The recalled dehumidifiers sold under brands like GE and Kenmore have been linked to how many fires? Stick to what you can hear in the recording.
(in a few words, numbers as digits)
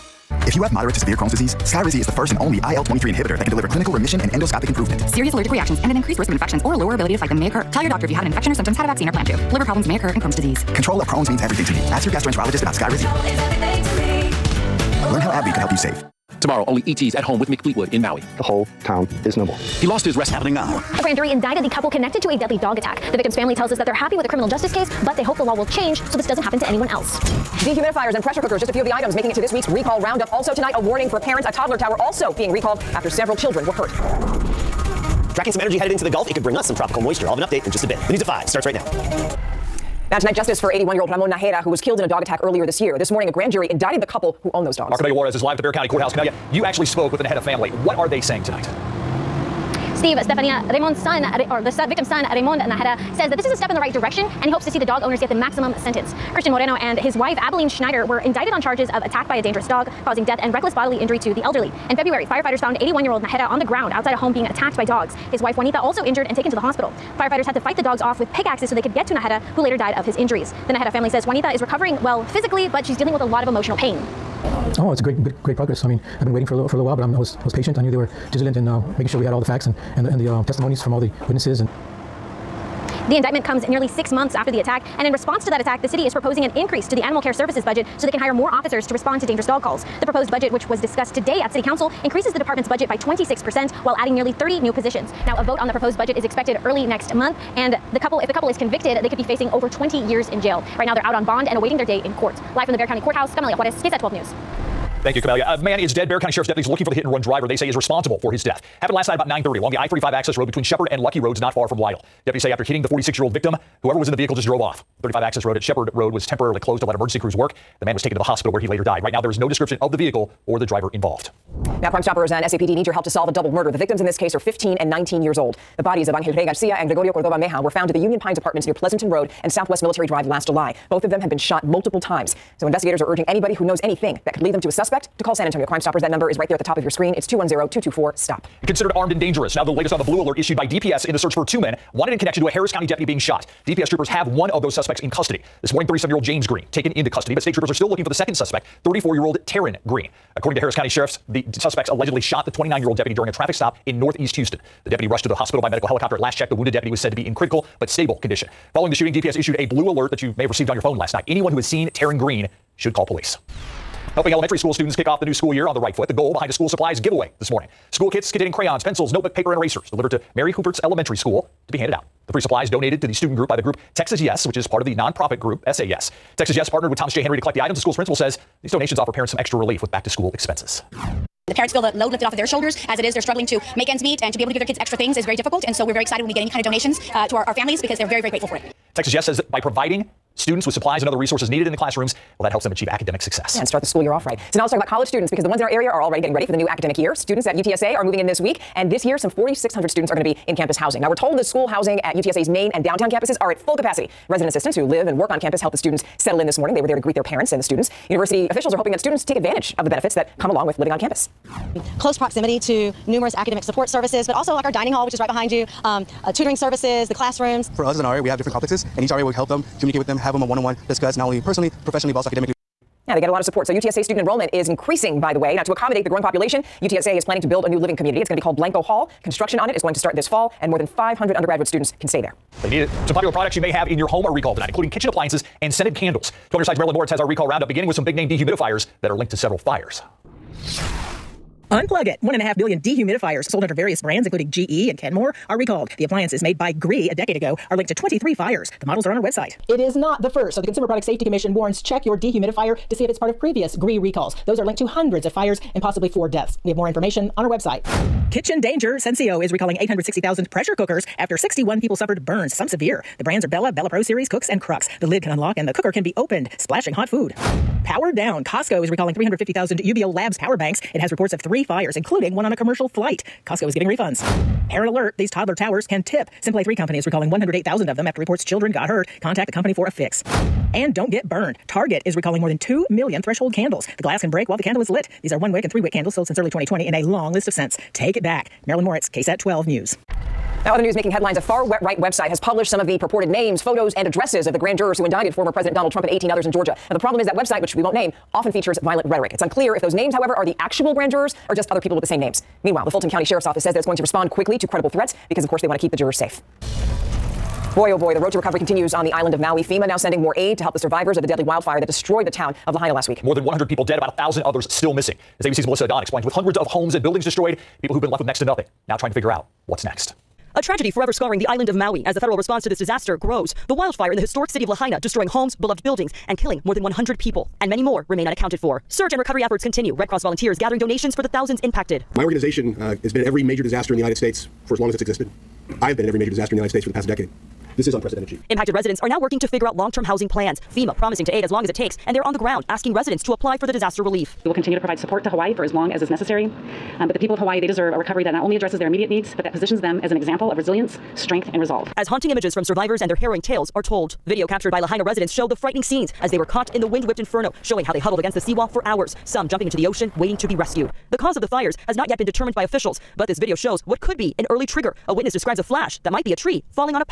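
23.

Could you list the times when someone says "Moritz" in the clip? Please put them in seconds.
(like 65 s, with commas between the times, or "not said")
236 s, 288 s.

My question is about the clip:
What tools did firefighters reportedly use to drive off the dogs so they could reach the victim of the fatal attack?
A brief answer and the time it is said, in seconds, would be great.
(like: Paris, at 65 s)
Pickaxes, at 68 s.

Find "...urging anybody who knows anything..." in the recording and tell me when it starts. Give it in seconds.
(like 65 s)
133 s.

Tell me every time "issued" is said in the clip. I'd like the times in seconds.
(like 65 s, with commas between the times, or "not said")
140 s, 159 s.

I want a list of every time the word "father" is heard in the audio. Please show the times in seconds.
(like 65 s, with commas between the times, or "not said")
not said.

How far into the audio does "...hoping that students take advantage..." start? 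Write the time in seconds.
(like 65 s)
208 s.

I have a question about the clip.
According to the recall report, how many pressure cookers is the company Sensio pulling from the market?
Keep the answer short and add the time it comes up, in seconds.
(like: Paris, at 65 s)
860,000, at 259 s.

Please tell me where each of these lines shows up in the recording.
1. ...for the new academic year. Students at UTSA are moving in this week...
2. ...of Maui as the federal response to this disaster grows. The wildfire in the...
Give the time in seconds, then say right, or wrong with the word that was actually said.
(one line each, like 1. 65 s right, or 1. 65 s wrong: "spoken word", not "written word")
1. 196 s right
2. 321 s right.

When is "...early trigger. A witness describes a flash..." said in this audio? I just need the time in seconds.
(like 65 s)
364 s.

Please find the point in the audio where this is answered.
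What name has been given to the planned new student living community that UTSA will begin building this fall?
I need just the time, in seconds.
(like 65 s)
228 s.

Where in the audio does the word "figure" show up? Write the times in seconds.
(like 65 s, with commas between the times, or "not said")
319 s, 339 s.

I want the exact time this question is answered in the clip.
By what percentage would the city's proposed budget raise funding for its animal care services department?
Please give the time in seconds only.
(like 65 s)
92 s.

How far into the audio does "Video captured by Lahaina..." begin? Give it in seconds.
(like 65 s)
354 s.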